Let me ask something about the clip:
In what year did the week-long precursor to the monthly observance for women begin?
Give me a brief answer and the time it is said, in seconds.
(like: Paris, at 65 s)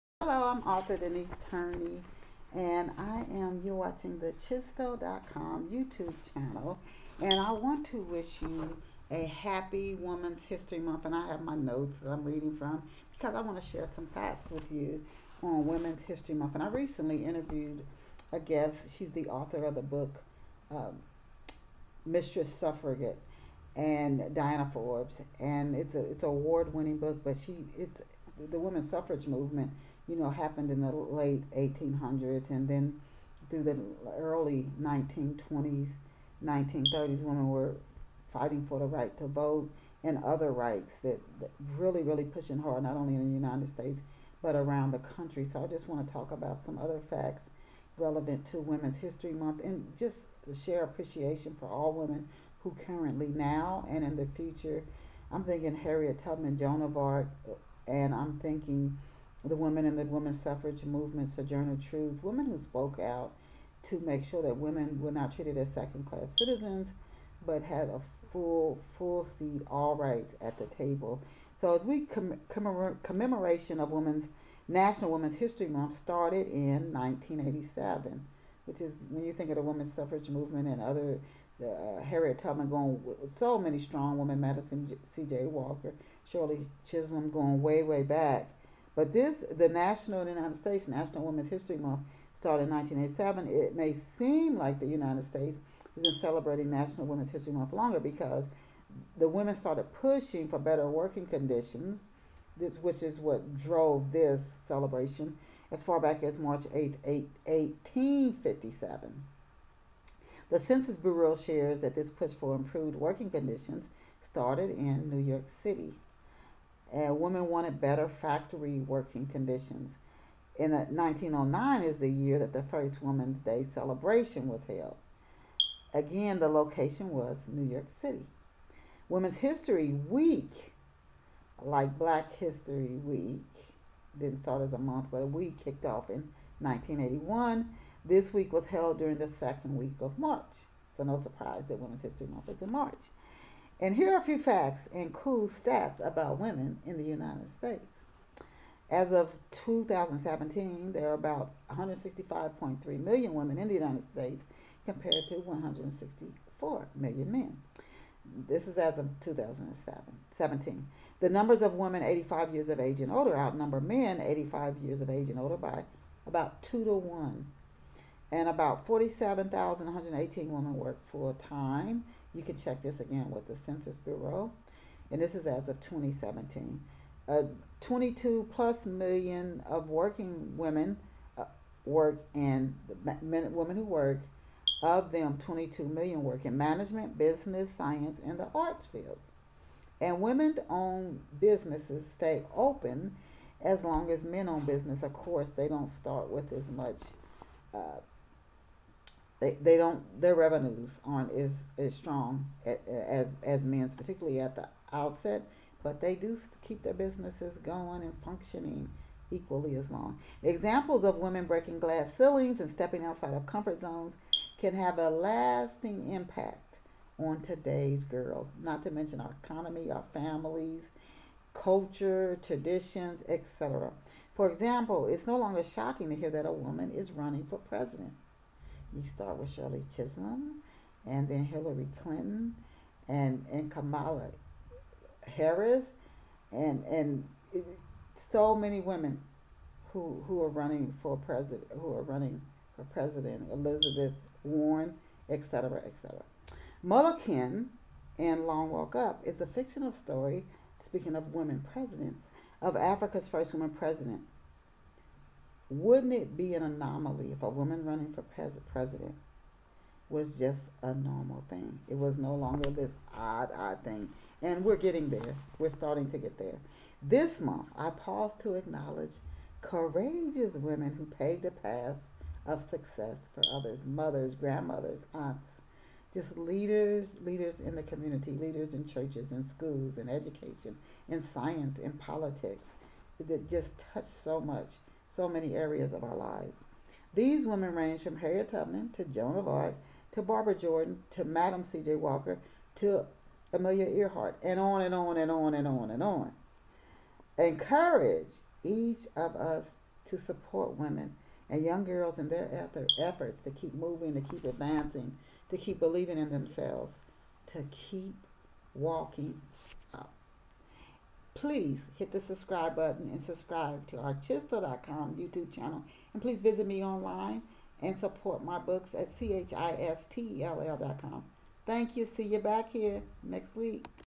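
1981, at 136 s.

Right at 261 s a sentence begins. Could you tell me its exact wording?
It was no longer this odd, odd thing.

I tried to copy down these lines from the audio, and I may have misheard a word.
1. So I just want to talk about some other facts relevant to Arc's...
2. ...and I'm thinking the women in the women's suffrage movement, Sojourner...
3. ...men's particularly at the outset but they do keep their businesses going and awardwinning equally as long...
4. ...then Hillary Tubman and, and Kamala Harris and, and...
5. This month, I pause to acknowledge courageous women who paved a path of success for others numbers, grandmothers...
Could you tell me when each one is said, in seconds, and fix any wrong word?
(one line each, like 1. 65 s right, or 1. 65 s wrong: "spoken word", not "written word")
1. 45 s wrong: "Women", not "Arc"
2. 57 s right
3. 203 s wrong: "functioning", not "awardwinning"
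4. 231 s wrong: "Clinton", not "Tubman"
5. 267 s wrong: "mothers", not "numbers".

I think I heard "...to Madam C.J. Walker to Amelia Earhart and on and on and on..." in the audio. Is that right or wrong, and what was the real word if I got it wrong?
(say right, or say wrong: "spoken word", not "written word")
right.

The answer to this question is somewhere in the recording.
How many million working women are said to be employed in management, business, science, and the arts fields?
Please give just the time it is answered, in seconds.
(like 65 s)
185 s.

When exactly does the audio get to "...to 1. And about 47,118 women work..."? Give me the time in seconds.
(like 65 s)
166 s.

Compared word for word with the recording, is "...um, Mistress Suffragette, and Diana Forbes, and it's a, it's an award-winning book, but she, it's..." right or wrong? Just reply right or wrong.
right.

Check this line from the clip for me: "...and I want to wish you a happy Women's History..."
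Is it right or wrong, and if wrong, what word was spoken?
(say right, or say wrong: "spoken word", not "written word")
right.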